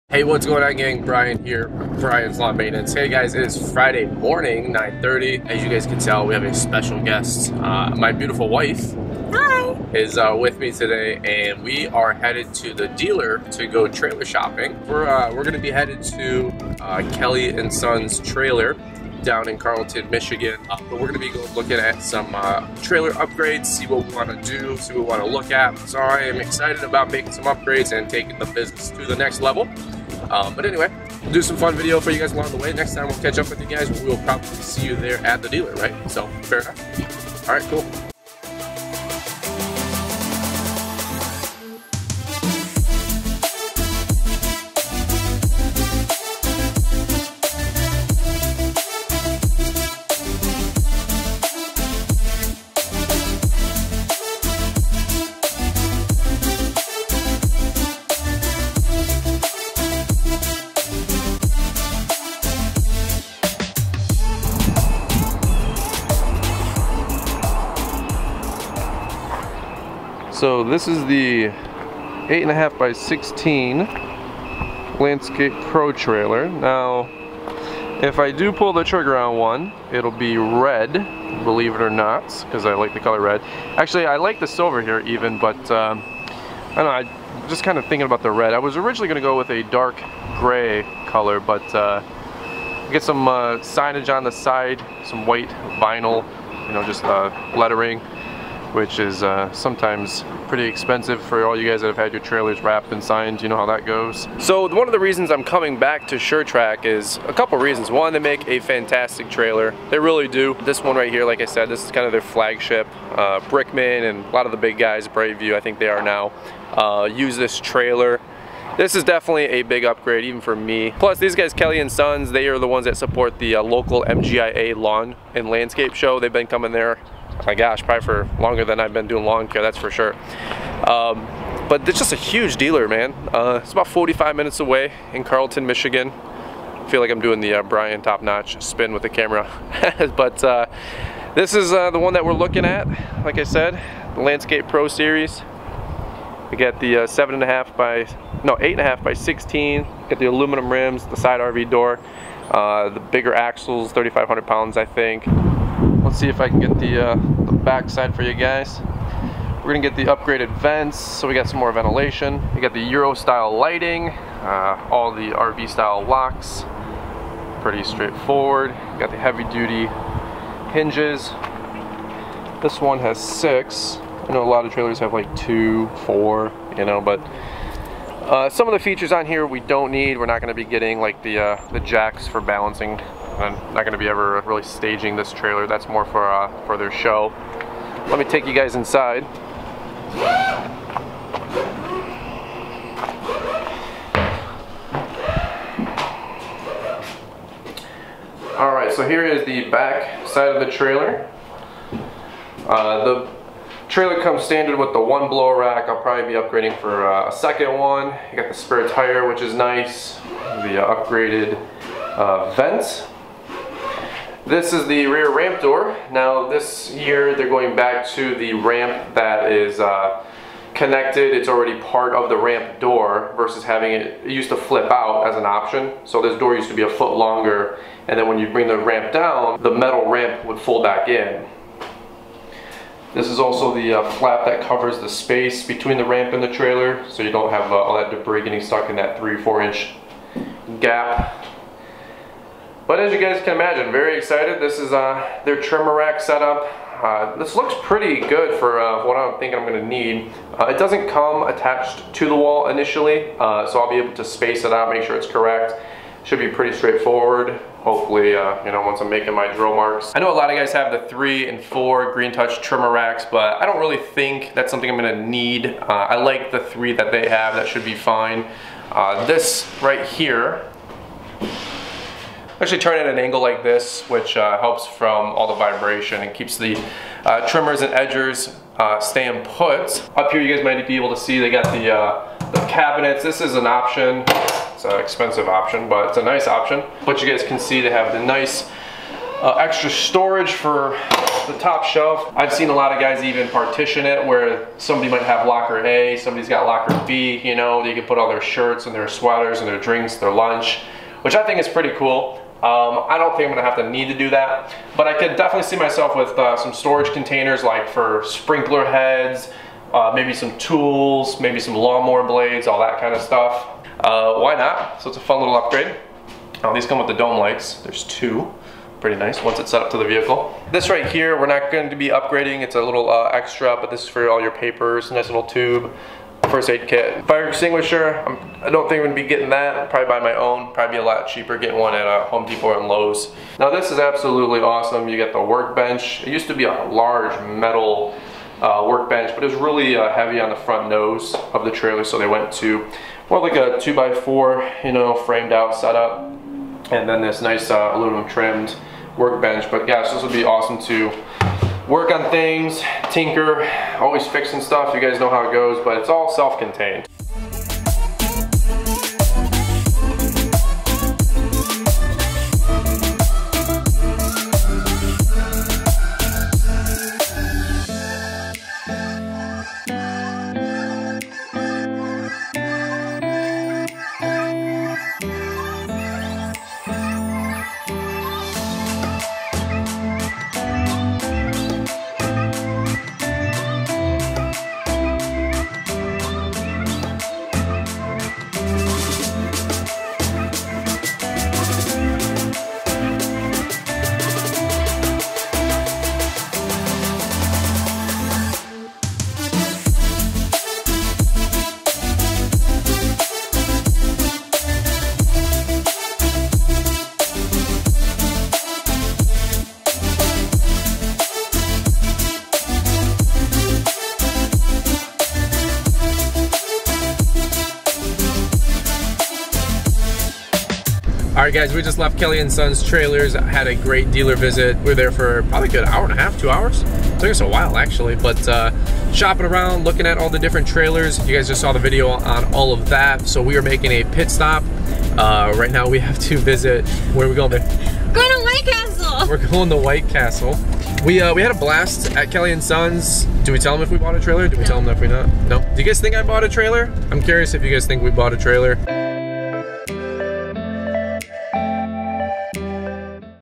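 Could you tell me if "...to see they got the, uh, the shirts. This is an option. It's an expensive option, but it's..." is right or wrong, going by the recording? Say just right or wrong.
wrong.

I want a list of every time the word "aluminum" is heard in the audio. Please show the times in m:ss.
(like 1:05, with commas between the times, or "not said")
2:30, 5:47.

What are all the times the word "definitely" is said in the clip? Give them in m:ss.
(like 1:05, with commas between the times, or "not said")
1:59, 5:05.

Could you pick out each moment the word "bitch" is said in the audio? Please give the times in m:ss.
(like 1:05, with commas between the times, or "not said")
not said.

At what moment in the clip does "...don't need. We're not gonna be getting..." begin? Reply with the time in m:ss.
2:59.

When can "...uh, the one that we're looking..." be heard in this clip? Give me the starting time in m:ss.
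2:21.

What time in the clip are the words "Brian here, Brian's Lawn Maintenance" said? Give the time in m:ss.
0:01.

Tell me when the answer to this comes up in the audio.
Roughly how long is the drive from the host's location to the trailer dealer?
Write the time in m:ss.
2:13.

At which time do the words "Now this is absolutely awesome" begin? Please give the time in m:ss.
5:33.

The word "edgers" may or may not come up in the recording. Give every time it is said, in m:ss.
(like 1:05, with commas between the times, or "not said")
4:37.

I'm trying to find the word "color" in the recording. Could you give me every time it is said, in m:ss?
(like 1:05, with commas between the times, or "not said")
1:22, 1:31.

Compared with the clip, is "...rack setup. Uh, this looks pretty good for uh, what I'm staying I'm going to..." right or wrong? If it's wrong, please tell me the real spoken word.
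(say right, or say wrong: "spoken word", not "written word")
wrong: "thinking", not "staying".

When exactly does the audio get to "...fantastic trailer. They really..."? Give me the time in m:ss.
1:48.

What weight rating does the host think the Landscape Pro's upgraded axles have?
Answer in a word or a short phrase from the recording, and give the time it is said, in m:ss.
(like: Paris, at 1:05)
3,500 pounds, at 2:33.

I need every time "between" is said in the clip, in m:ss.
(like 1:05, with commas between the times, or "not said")
3:55.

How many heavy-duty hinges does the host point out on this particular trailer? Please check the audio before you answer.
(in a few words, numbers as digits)
6.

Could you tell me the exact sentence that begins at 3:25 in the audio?
I'll probably be upgrading for uh, a second one.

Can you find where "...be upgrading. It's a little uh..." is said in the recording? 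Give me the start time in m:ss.
5:21.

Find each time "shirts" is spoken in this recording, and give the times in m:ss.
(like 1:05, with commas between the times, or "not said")
4:58.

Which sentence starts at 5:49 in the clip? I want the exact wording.
But gosh, this would be awesome to work on things, tinker, always fixing stuff.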